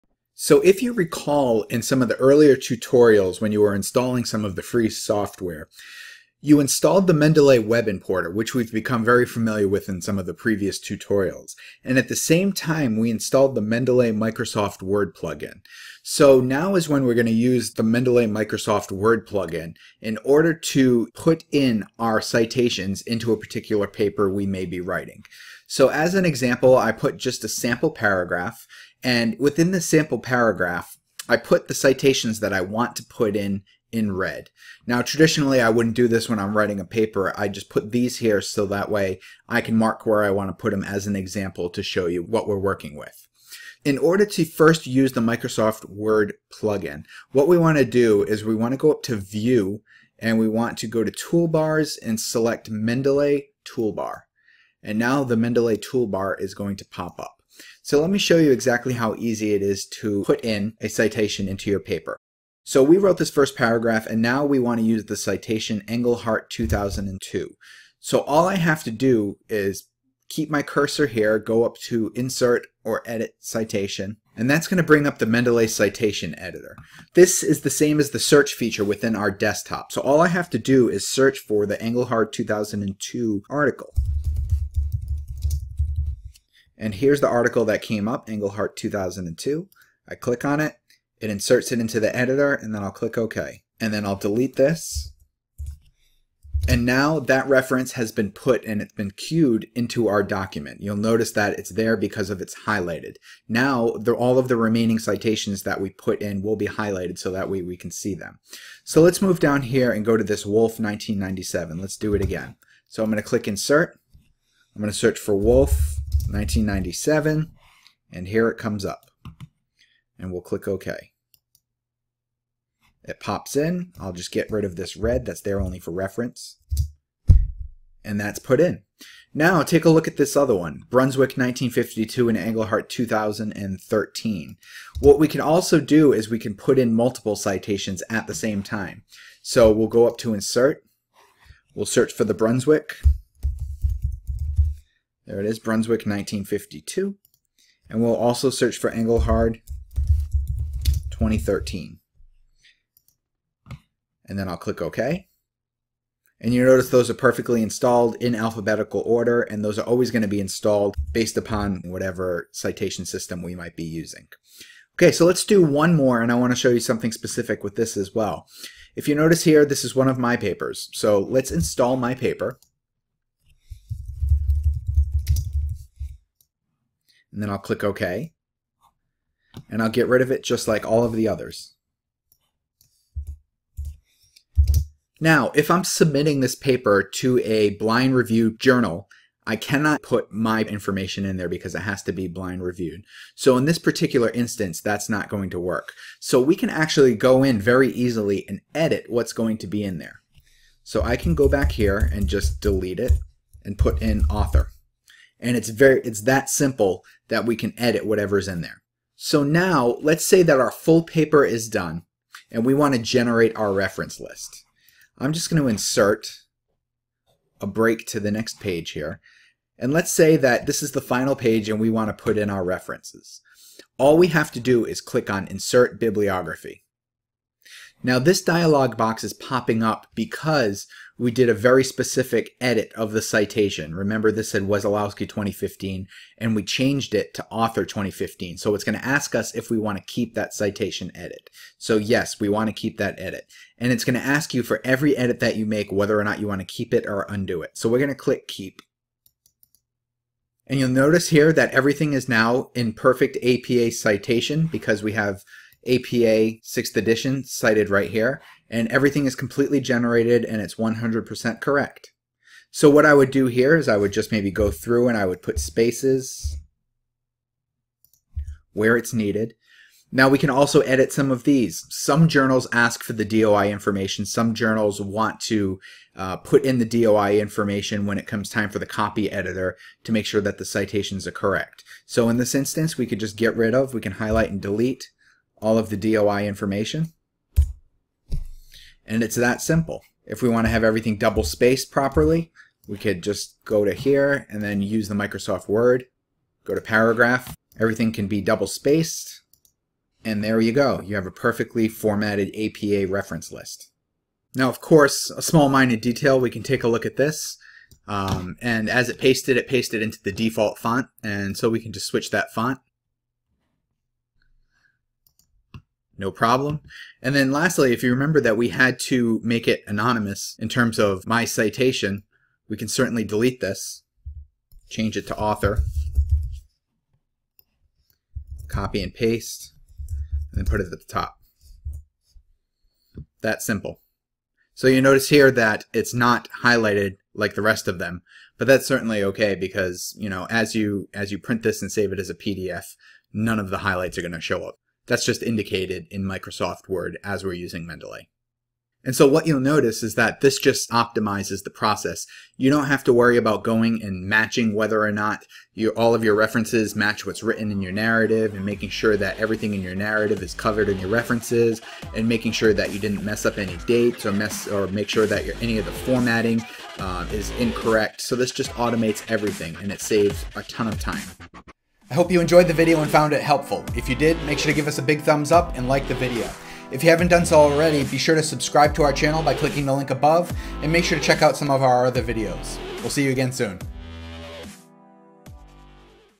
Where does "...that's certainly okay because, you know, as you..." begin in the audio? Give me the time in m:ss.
5:38.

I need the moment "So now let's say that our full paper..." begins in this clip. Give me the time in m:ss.
3:29.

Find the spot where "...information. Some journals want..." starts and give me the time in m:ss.
4:33.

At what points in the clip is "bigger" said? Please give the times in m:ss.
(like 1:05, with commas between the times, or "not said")
not said.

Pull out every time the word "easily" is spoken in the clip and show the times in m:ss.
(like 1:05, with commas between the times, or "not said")
3:17.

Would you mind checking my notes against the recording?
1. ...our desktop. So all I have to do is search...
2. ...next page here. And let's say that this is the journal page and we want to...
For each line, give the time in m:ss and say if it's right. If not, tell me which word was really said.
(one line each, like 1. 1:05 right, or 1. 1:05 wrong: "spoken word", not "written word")
1. 1:19 right
2. 3:38 wrong: "final", not "journal".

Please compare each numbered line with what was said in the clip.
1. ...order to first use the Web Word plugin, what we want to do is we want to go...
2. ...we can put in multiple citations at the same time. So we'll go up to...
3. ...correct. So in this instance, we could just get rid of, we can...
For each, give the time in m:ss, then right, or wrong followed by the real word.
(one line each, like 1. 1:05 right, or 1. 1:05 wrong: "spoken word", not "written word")
1. 0:43 wrong: "Microsoft", not "Web"
2. 2:16 right
3. 4:41 right.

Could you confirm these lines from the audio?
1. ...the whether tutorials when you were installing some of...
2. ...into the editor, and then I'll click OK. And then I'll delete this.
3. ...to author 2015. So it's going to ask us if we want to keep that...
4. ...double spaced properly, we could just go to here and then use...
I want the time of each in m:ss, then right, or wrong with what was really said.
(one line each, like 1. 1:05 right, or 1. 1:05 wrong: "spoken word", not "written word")
1. 0:02 wrong: "earlier", not "whether"
2. 1:31 right
3. 3:57 right
4. 4:51 right.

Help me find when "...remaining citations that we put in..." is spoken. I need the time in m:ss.
1:44.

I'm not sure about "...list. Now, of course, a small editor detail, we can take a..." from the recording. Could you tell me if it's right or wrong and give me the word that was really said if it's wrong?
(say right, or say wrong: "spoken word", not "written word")
wrong: "minor", not "editor".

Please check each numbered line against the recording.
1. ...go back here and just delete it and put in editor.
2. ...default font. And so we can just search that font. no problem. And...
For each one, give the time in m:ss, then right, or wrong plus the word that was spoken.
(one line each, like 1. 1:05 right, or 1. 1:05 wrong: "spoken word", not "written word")
1. 3:21 wrong: "author", not "editor"
2. 5:10 wrong: "switch", not "search".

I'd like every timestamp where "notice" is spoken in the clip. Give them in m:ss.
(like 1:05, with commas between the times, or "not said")
1:40, 2:36, 2:49, 4:10, 5:35, 5:49.